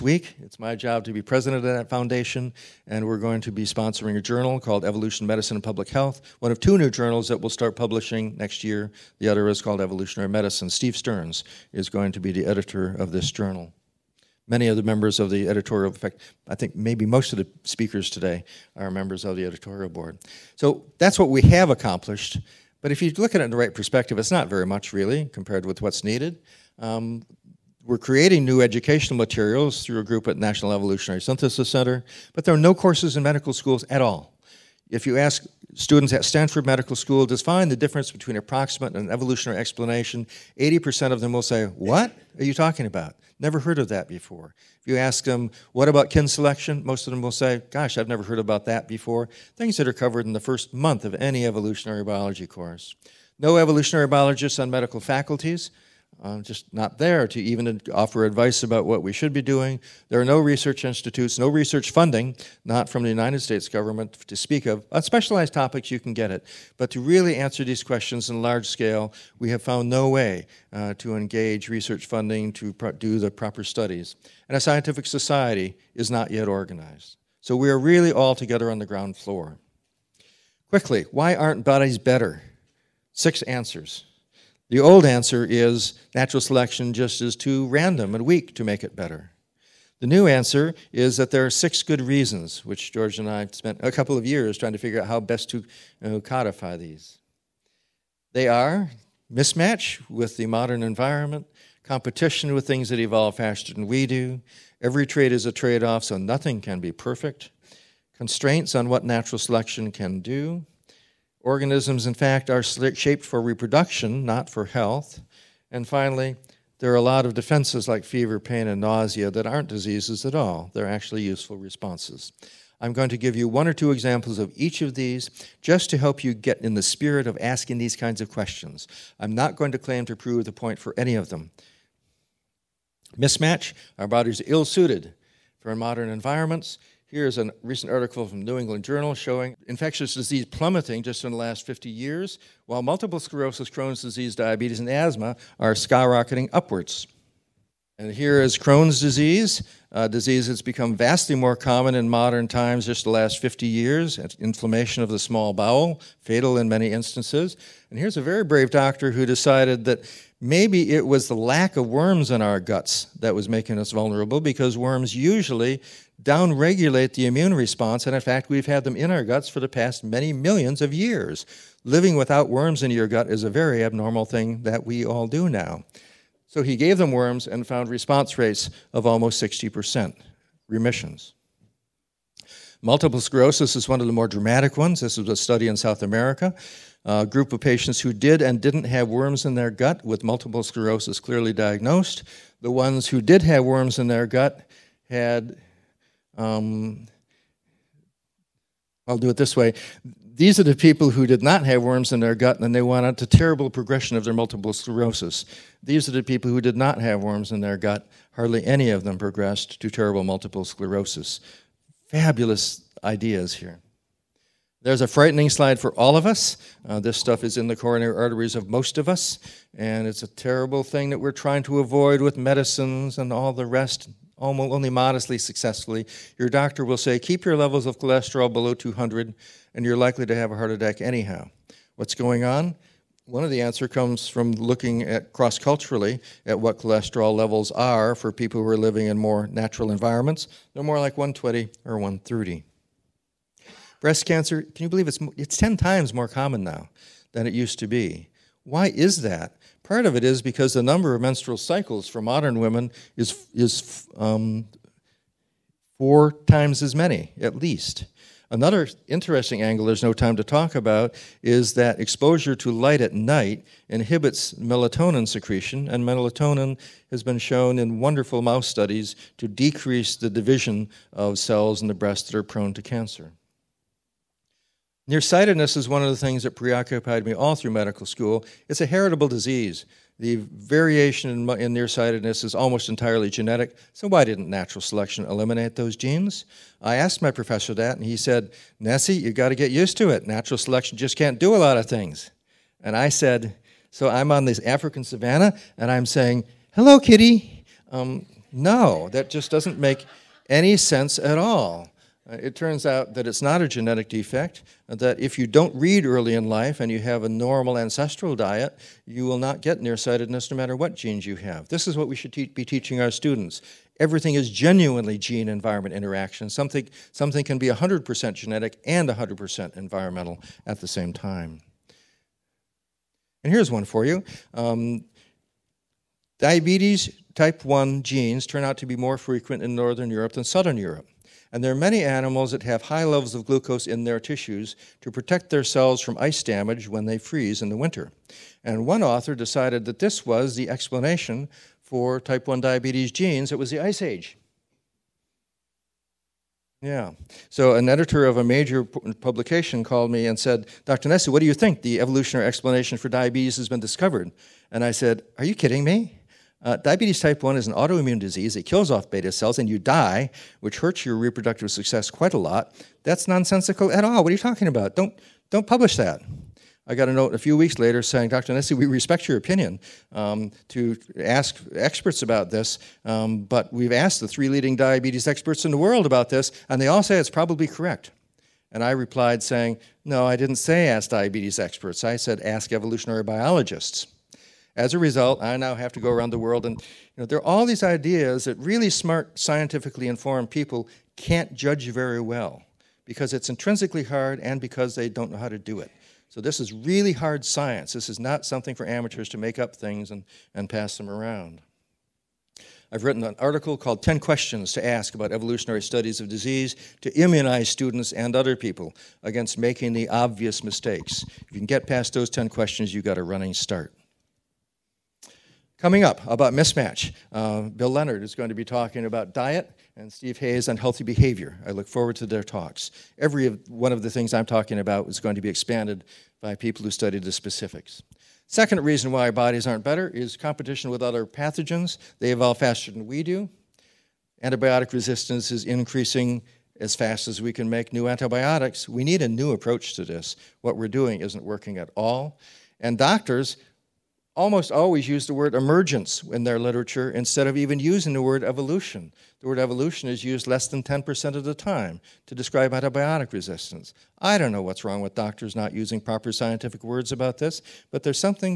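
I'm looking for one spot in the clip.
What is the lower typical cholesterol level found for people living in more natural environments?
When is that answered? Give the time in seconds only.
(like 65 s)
241 s.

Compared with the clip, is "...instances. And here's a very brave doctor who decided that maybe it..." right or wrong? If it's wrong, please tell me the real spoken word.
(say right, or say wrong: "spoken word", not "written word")
right.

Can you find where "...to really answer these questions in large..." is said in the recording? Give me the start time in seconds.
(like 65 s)
66 s.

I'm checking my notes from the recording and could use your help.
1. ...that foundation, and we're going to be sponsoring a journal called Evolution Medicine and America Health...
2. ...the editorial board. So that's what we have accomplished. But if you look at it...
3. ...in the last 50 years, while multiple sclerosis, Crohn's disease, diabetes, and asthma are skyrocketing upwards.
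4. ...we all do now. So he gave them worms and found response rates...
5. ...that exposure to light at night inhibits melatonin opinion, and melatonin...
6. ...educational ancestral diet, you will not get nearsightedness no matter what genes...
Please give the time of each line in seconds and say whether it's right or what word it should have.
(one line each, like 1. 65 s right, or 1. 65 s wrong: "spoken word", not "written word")
1. 1 s wrong: "Public", not "America"
2. 19 s right
3. 141 s right
4. 174 s right
5. 261 s wrong: "secretion", not "opinion"
6. 307 s wrong: "normal", not "educational".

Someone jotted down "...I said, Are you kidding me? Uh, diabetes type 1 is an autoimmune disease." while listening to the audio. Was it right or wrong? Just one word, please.
right.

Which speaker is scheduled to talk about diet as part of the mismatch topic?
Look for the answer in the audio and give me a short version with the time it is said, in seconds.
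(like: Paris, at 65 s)
Bill Leonard, at 417 s.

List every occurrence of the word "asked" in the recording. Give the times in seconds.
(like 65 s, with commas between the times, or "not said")
286 s, 373 s.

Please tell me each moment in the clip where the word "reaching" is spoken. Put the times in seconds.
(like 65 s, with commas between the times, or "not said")
not said.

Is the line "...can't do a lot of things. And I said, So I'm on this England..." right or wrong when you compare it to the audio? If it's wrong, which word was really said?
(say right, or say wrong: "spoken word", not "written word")
wrong: "African", not "England".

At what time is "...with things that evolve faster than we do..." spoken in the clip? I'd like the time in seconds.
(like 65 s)
102 s.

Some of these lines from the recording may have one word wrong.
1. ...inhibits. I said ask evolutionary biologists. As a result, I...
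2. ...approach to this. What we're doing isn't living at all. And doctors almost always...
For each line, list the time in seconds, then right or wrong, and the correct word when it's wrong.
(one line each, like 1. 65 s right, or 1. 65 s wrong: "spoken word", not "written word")
1. 381 s wrong: "experts", not "inhibits"
2. 439 s wrong: "working", not "living".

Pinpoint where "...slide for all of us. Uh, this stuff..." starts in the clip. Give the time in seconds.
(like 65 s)
215 s.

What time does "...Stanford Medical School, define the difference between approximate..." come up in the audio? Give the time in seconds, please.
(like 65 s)
36 s.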